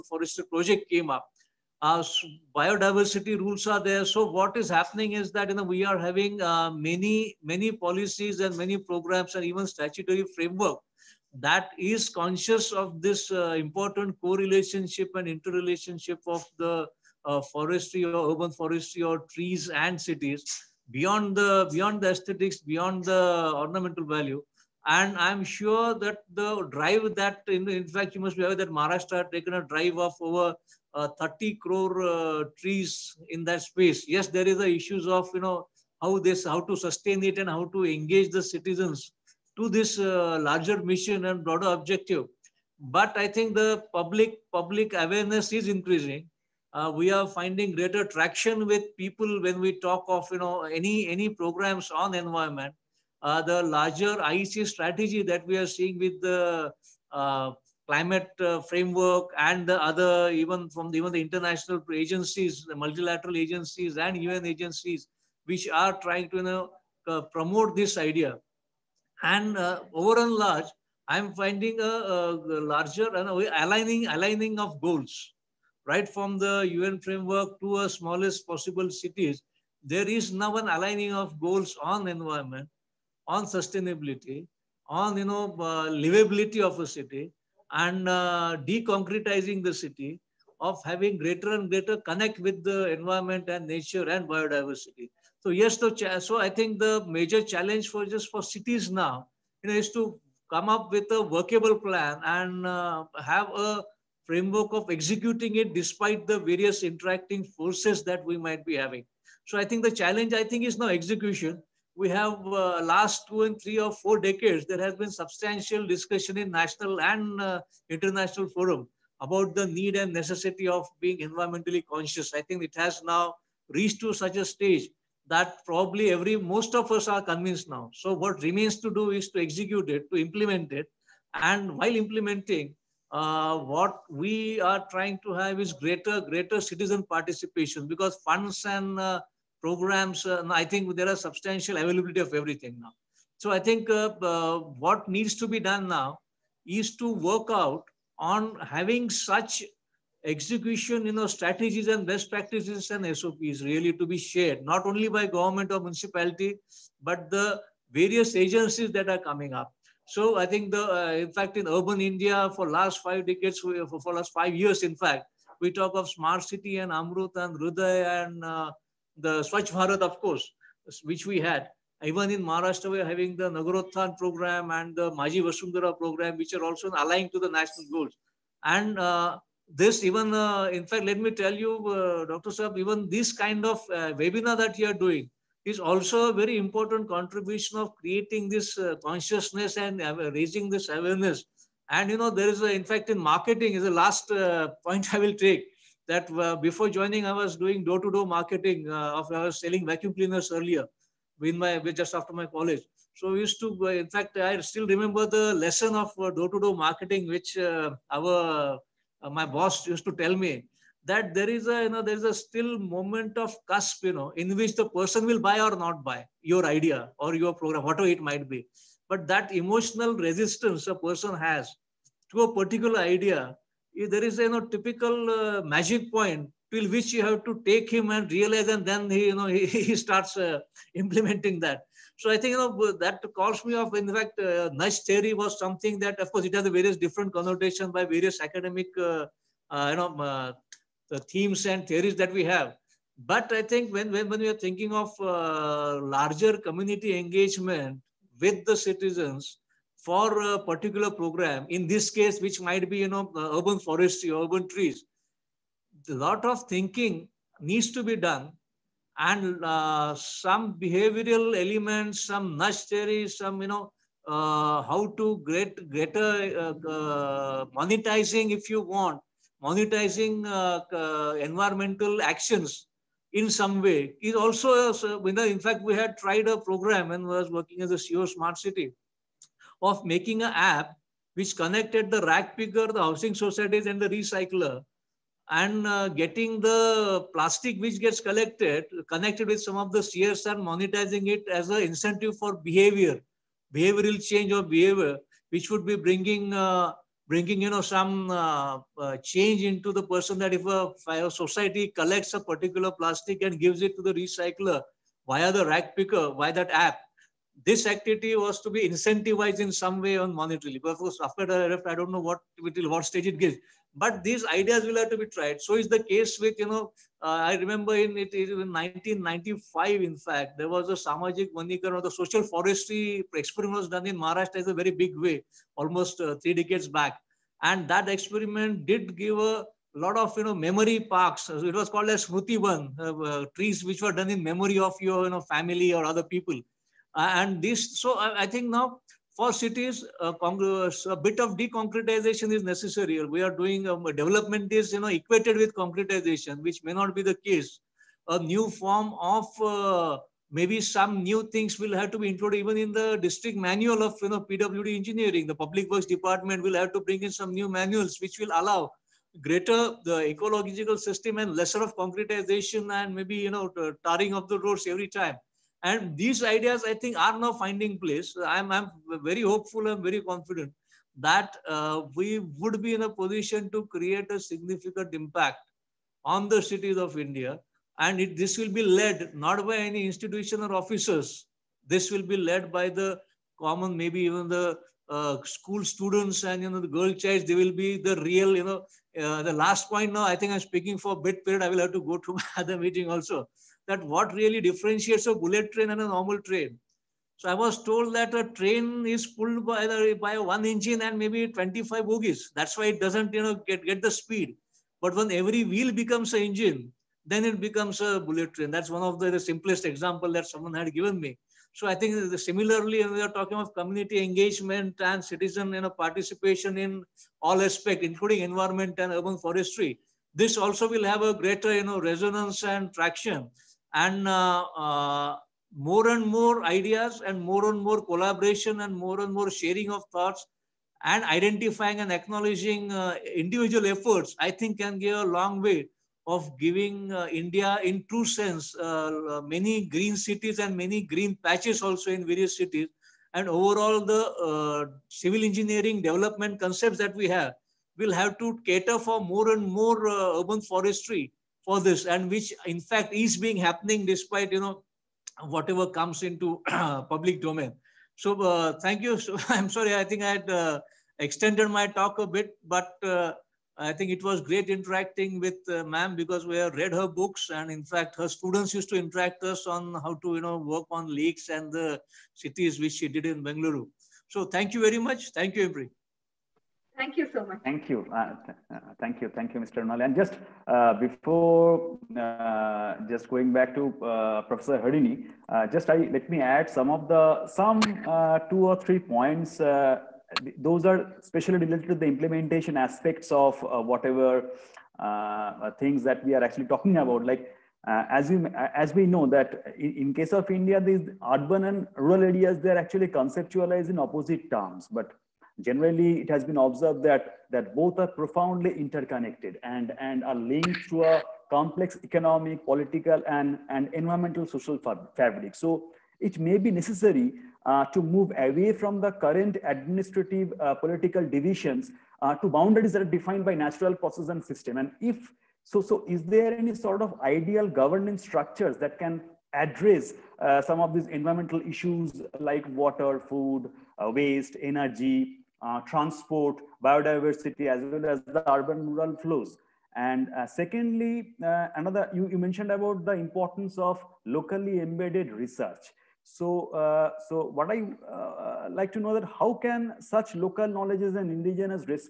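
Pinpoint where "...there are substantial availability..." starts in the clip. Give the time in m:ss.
2:20.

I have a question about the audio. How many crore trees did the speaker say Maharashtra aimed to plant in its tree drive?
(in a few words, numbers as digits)
30 crore.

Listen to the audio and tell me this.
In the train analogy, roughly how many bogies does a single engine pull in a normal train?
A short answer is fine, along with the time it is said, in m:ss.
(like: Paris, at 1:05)
25, at 6:41.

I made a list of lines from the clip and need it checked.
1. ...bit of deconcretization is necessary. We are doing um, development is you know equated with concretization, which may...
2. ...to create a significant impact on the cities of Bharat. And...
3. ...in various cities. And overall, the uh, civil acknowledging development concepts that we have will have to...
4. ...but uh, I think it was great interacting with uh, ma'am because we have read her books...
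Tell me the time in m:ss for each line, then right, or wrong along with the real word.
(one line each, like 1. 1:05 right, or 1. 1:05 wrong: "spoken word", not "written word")
1. 5:41 right
2. 6:13 wrong: "India", not "Bharat"
3. 7:22 wrong: "engineering", not "acknowledging"
4. 7:42 right.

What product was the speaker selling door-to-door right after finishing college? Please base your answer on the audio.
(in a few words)
vacuum cleaners.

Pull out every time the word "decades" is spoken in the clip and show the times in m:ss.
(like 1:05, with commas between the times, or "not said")
1:54, 2:43, 5:26.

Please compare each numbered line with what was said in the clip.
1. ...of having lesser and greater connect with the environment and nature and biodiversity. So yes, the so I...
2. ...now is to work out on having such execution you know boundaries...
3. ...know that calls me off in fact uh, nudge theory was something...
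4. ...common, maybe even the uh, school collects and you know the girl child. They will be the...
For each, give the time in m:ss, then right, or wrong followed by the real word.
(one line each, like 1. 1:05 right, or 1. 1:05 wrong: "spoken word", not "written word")
1. 1:30 wrong: "greater", not "lesser"
2. 2:25 wrong: "strategies", not "boundaries"
3. 3:52 right
4. 6:23 wrong: "students", not "collects".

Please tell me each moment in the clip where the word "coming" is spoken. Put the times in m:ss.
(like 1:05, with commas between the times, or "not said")
2:39.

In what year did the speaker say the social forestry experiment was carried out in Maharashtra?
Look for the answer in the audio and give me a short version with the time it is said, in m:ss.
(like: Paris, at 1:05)
1995, at 5:18.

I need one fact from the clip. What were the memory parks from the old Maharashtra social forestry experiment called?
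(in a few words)
Smrutivan.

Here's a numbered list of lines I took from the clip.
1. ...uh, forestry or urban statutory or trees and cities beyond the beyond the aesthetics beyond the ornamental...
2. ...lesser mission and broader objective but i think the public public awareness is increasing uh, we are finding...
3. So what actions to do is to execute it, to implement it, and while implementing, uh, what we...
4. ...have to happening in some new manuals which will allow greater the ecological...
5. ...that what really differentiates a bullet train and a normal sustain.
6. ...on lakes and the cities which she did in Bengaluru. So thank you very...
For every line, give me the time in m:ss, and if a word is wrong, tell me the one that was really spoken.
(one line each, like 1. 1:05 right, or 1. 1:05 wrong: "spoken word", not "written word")
1. 0:17 wrong: "forestry", not "statutory"
2. 0:40 wrong: "larger", not "lesser"
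3. 2:07 wrong: "remains", not "actions"
4. 5:56 wrong: "bring", not "happening"
5. 6:33 wrong: "train", not "sustain"
6. 7:50 right.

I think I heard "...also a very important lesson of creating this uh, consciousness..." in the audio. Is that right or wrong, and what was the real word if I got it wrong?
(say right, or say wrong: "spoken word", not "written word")
wrong: "contribution", not "lesson".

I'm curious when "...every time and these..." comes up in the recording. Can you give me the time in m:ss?
6:04.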